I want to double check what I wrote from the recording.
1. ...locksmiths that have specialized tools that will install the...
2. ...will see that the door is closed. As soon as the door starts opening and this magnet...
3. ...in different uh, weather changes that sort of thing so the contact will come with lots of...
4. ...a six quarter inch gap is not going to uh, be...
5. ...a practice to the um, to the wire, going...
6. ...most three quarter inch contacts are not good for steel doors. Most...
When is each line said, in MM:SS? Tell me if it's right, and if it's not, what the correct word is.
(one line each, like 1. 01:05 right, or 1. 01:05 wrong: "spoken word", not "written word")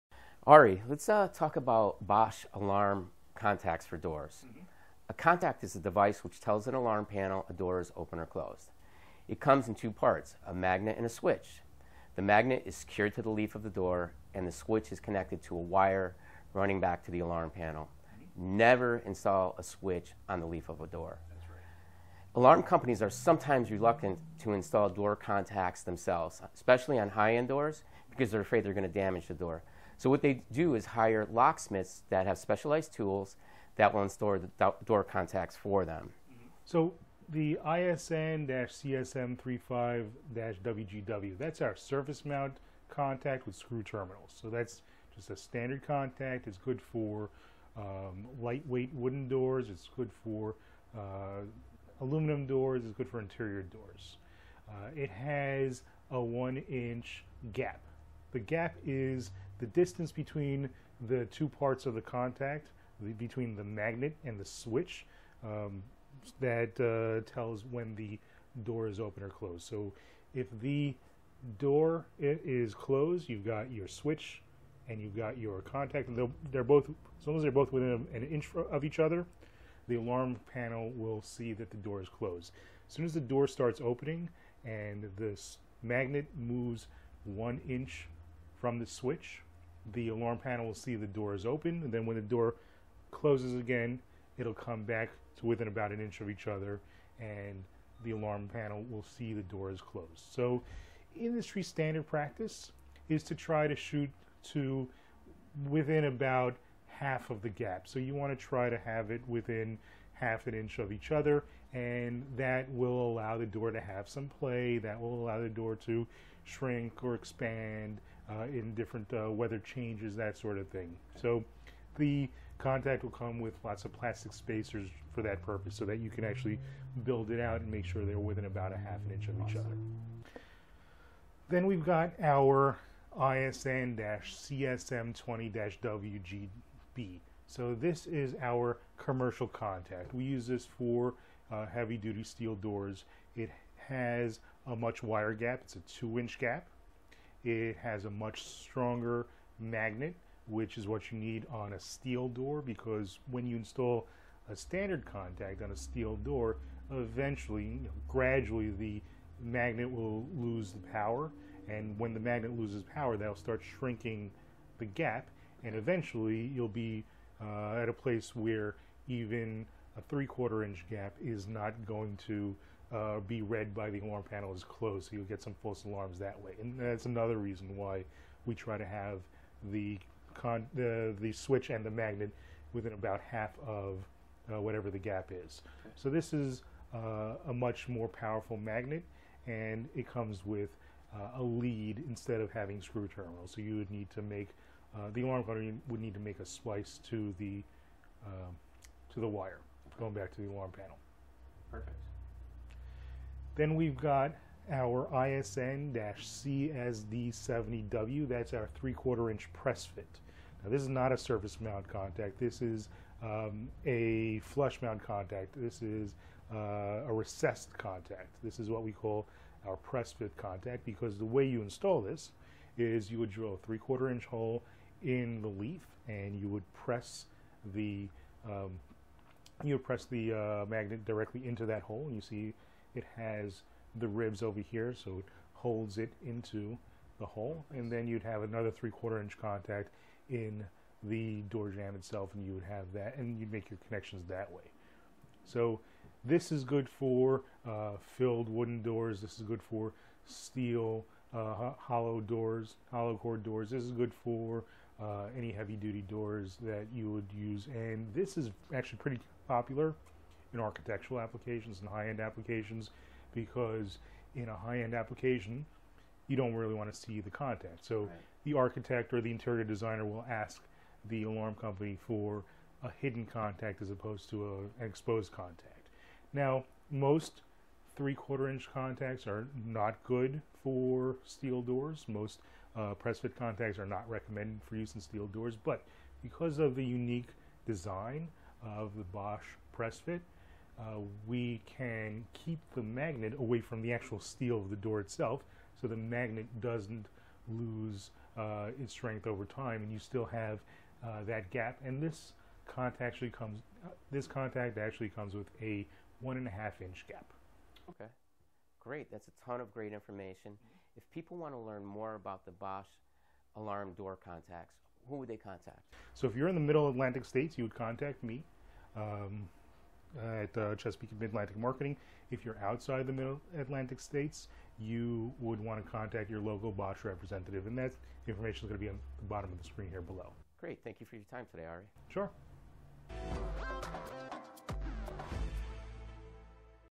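1. 00:31 right
2. 01:20 right
3. 01:58 right
4. 02:49 wrong: "three", not "six"
5. 03:16 wrong: "splice", not "practice"
6. 04:36 right.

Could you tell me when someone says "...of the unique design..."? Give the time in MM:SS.
04:46.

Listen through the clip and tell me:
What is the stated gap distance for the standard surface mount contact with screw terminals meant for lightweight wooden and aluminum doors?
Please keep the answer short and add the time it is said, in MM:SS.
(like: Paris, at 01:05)
1 inch, at 00:56.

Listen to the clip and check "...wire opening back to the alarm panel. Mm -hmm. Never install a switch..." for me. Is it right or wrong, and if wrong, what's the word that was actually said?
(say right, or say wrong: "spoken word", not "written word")
wrong: "running", not "opening".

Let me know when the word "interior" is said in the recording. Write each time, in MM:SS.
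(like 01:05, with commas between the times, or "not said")
00:53, 04:29.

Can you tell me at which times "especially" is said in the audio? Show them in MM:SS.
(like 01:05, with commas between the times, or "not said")
00:26.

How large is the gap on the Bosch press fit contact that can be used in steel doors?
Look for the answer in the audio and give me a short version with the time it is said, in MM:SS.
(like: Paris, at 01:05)
1.5 inch, at 05:06.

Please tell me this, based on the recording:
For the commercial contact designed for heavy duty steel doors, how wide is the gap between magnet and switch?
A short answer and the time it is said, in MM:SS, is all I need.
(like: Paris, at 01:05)
2 inch, at 02:25.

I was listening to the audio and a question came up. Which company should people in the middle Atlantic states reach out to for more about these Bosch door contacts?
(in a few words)
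Chesapeake Midlantic Marketing.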